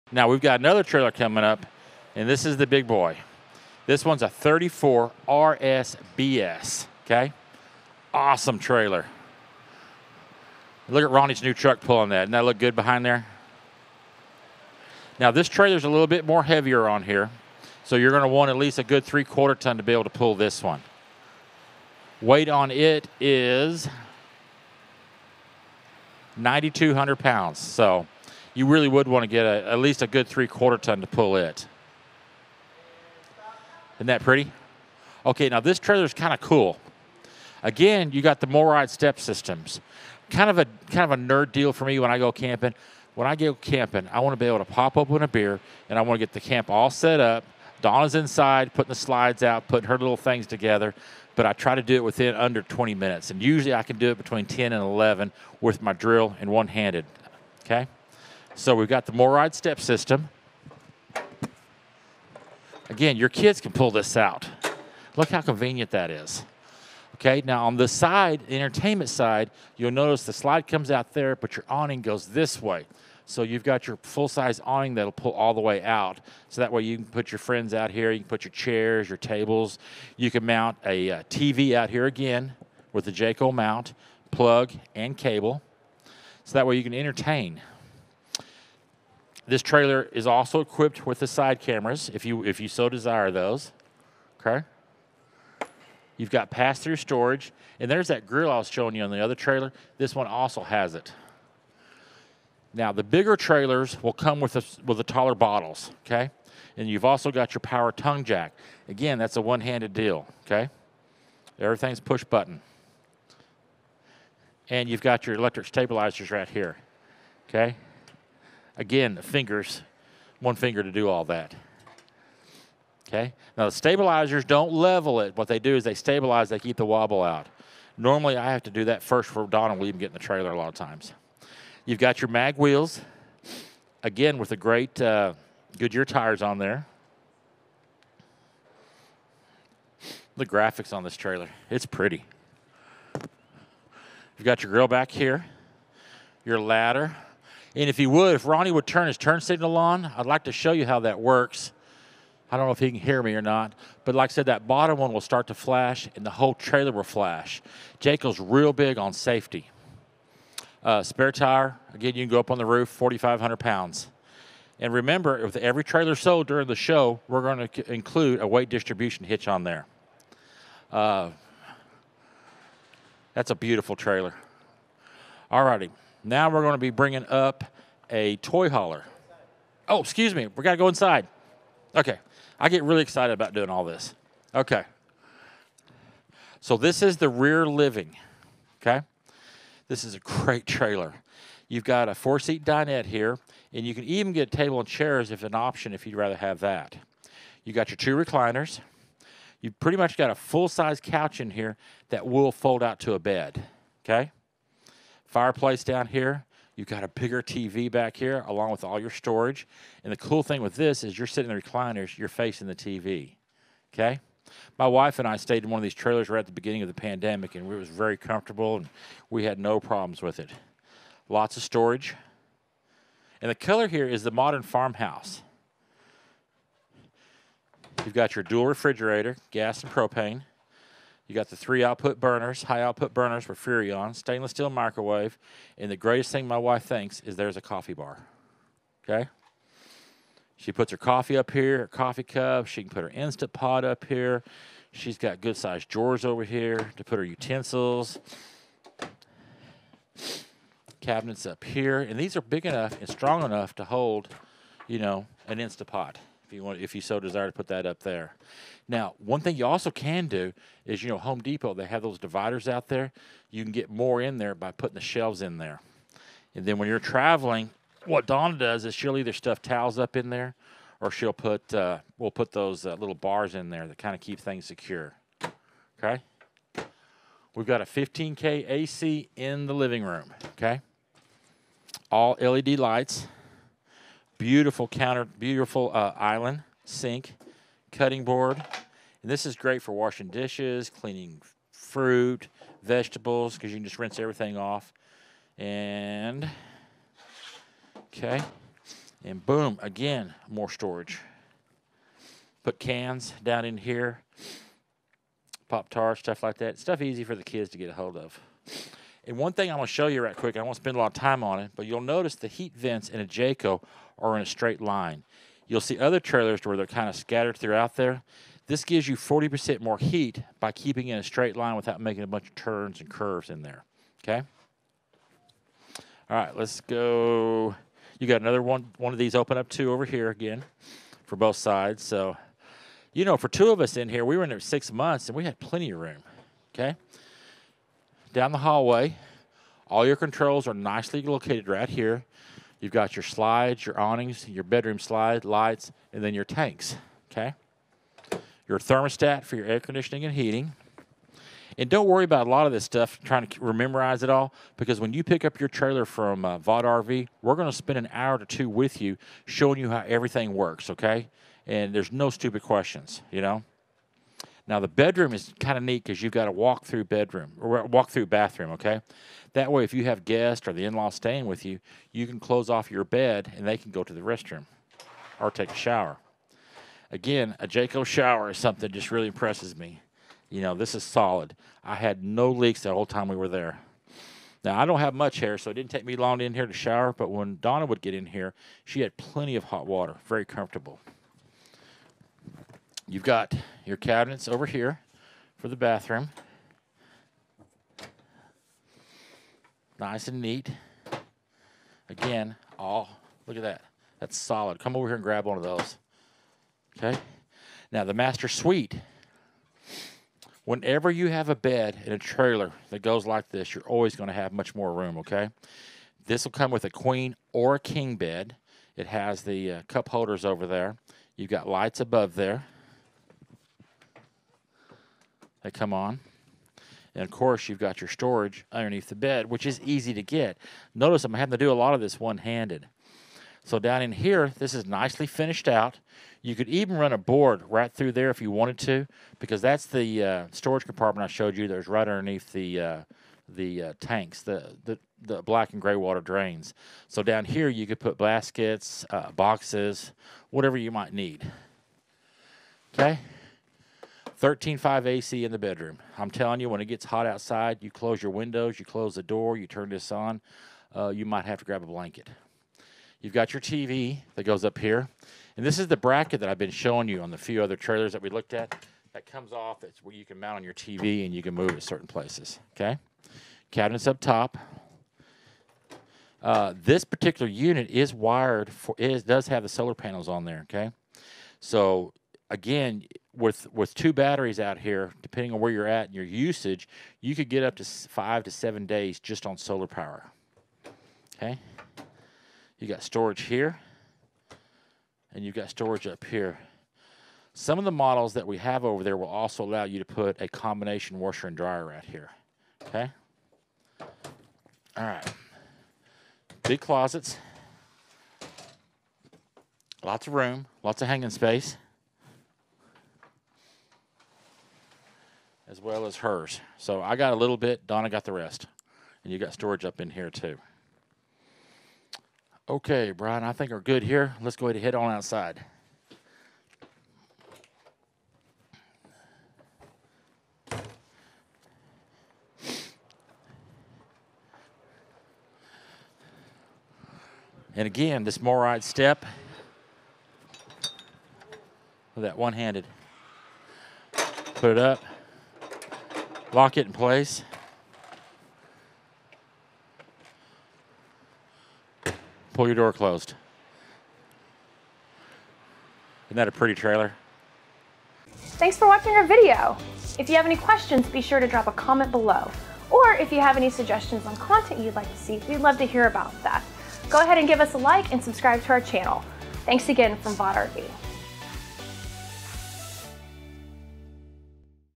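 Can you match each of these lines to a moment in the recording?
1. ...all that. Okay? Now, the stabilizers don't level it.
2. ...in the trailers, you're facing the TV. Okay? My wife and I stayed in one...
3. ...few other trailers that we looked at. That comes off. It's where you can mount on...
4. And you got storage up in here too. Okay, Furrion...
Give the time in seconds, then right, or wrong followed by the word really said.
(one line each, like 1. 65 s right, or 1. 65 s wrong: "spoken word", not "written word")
1. 121 s right
2. 211 s wrong: "recliners", not "trailers"
3. 467 s right
4. 519 s wrong: "Brian", not "Furrion".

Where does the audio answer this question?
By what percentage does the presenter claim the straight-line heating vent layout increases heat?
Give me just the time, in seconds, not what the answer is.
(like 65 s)
319 s.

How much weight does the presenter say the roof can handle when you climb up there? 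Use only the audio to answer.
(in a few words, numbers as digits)
4,500 pounds.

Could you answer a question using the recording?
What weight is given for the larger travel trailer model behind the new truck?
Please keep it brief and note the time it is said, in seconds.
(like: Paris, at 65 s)
9,200 pounds, at 26 s.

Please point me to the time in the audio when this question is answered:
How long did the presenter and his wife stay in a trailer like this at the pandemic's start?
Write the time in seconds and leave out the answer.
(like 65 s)
334 s.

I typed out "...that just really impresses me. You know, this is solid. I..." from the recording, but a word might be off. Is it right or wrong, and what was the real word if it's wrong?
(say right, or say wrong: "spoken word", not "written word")
right.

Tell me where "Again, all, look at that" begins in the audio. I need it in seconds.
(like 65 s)
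402 s.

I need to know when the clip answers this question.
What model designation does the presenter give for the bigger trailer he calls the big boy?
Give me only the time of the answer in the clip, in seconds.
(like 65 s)
4 s.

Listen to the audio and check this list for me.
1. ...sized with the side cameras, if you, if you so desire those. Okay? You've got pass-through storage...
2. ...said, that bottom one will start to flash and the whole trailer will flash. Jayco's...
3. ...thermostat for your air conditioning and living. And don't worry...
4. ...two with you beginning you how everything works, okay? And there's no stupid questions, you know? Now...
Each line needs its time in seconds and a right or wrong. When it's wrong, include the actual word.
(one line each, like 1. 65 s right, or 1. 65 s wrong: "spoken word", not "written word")
1. 90 s wrong: "equipped", not "sized"
2. 154 s right
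3. 348 s wrong: "heating", not "living"
4. 358 s wrong: "showing", not "beginning".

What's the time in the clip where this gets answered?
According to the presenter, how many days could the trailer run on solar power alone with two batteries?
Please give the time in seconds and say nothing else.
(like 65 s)
487 s.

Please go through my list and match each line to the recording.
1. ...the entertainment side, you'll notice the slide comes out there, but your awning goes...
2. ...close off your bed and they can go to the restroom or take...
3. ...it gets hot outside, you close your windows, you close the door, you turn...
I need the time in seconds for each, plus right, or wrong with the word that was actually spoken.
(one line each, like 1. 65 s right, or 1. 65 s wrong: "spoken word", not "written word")
1. 68 s right
2. 372 s right
3. 456 s right.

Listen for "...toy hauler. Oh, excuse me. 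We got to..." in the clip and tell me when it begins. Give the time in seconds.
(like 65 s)
178 s.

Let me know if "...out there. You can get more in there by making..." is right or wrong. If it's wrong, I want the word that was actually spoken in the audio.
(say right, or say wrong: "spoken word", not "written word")
wrong: "putting", not "making".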